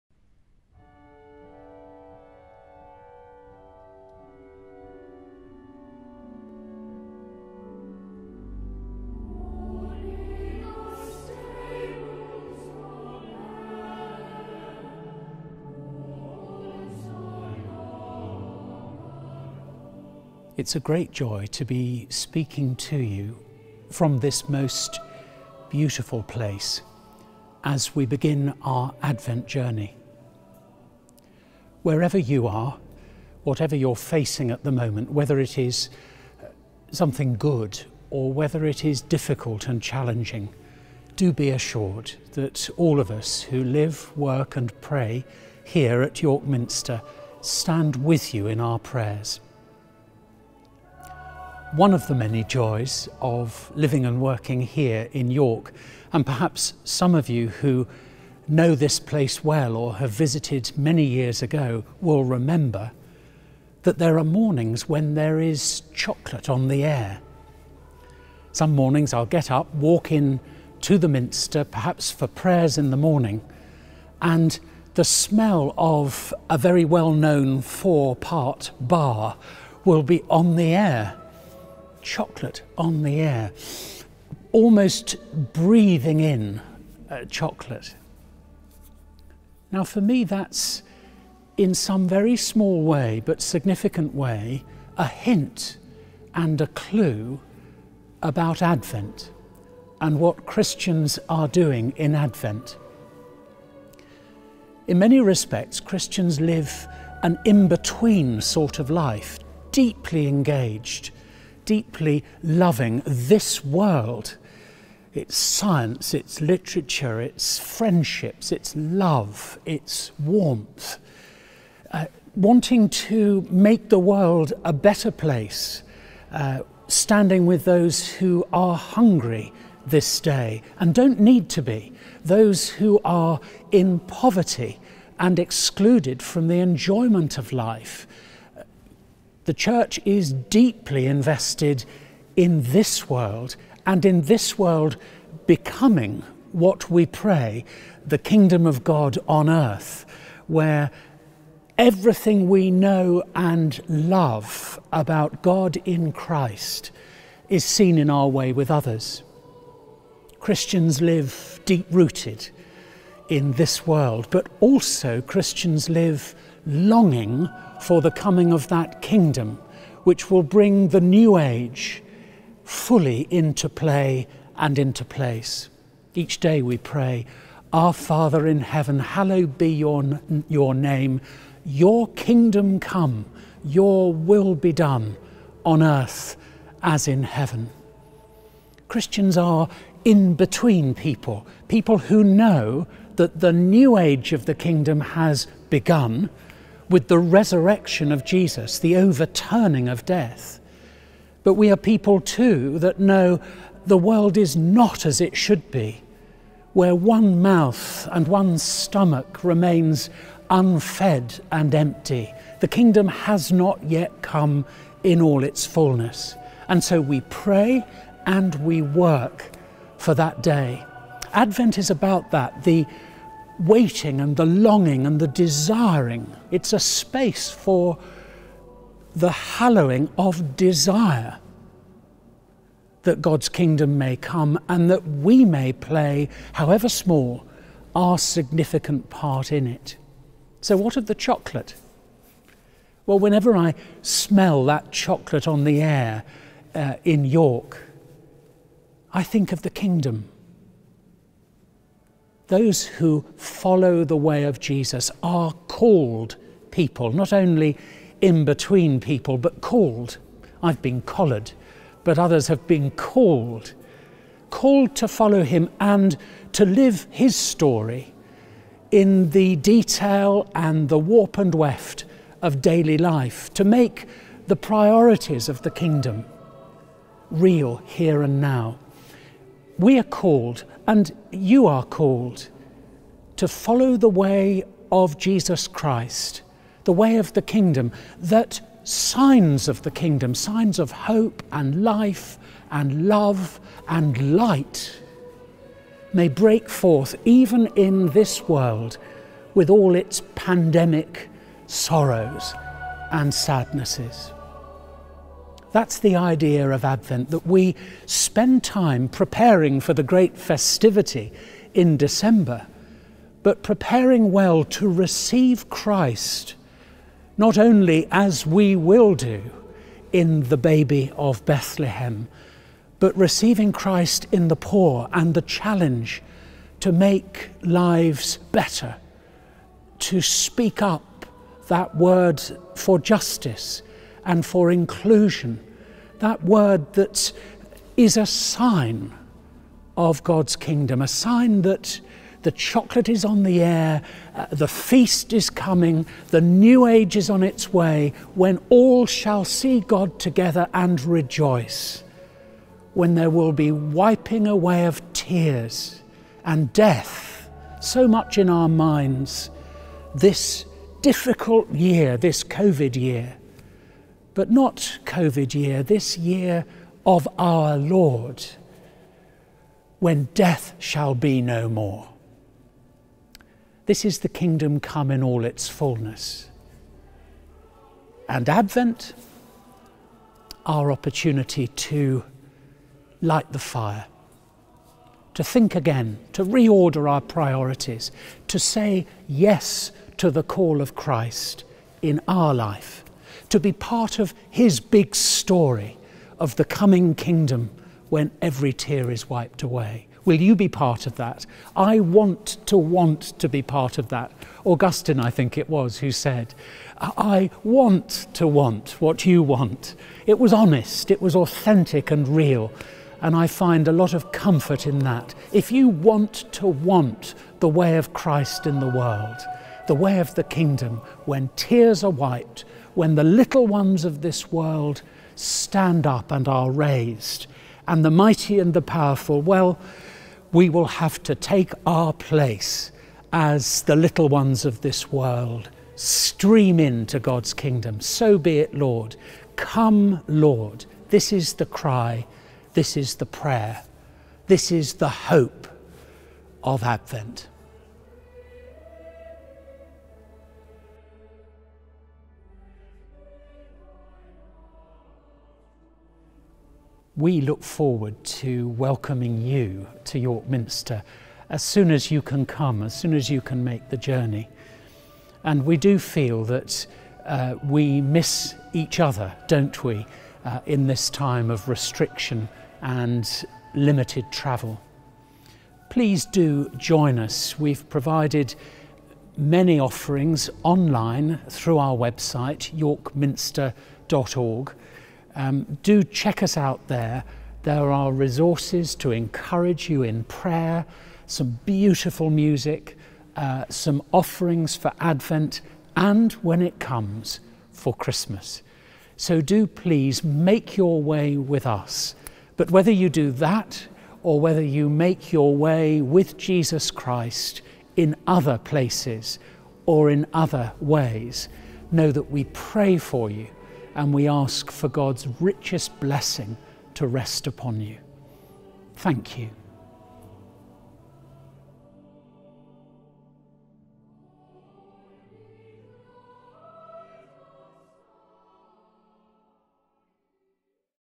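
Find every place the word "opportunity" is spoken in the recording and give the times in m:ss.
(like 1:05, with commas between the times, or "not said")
6:20.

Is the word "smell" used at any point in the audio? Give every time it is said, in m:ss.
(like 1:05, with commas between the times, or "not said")
1:15, 4:04.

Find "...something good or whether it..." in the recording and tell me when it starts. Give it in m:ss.
0:36.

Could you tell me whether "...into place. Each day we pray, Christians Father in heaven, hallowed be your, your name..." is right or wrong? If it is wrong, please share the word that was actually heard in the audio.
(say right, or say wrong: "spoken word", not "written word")
wrong: "Our", not "Christians".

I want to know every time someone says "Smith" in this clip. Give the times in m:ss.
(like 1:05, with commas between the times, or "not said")
not said.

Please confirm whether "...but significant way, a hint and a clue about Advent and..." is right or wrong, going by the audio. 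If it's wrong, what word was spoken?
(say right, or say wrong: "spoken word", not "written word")
right.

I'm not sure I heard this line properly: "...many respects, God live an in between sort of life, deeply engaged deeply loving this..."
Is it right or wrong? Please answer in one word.
wrong.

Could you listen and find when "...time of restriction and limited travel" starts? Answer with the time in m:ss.
7:51.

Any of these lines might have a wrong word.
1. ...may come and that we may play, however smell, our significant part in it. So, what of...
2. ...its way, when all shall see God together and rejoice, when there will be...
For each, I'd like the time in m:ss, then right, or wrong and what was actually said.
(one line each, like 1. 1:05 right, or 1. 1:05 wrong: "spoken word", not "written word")
1. 3:53 wrong: "small", not "smell"
2. 5:47 right.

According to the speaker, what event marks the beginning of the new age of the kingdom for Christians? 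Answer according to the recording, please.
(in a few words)
Resurrection of Jesus.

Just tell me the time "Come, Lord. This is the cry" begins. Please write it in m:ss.
7:19.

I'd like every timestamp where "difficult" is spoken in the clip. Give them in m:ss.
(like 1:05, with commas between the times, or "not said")
0:39, 6:01.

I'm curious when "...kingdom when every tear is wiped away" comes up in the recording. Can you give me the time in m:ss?
6:37.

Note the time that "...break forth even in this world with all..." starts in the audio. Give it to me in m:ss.
4:56.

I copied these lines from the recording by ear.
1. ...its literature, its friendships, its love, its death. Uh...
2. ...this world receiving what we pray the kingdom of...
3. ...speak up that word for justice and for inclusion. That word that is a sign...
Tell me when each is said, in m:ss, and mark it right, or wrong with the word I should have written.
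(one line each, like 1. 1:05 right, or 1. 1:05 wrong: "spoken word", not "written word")
1. 1:56 wrong: "warmth", not "death"
2. 2:24 wrong: "becoming", not "receiving"
3. 5:30 right.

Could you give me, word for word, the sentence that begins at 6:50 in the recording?
It was honest, it was authentic and real.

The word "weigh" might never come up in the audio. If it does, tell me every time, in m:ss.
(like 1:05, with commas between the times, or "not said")
not said.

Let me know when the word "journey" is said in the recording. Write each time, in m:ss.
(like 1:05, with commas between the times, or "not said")
0:29, 7:43.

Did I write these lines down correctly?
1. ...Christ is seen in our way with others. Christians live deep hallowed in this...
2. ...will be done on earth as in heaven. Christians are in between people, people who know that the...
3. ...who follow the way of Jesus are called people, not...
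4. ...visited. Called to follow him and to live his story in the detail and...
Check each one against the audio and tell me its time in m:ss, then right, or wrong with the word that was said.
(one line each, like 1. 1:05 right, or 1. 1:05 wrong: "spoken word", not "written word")
1. 2:36 wrong: "rooted", not "hallowed"
2. 3:04 right
3. 4:12 right
4. 4:22 wrong: "called", not "visited".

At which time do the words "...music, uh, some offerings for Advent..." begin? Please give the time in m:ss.
8:12.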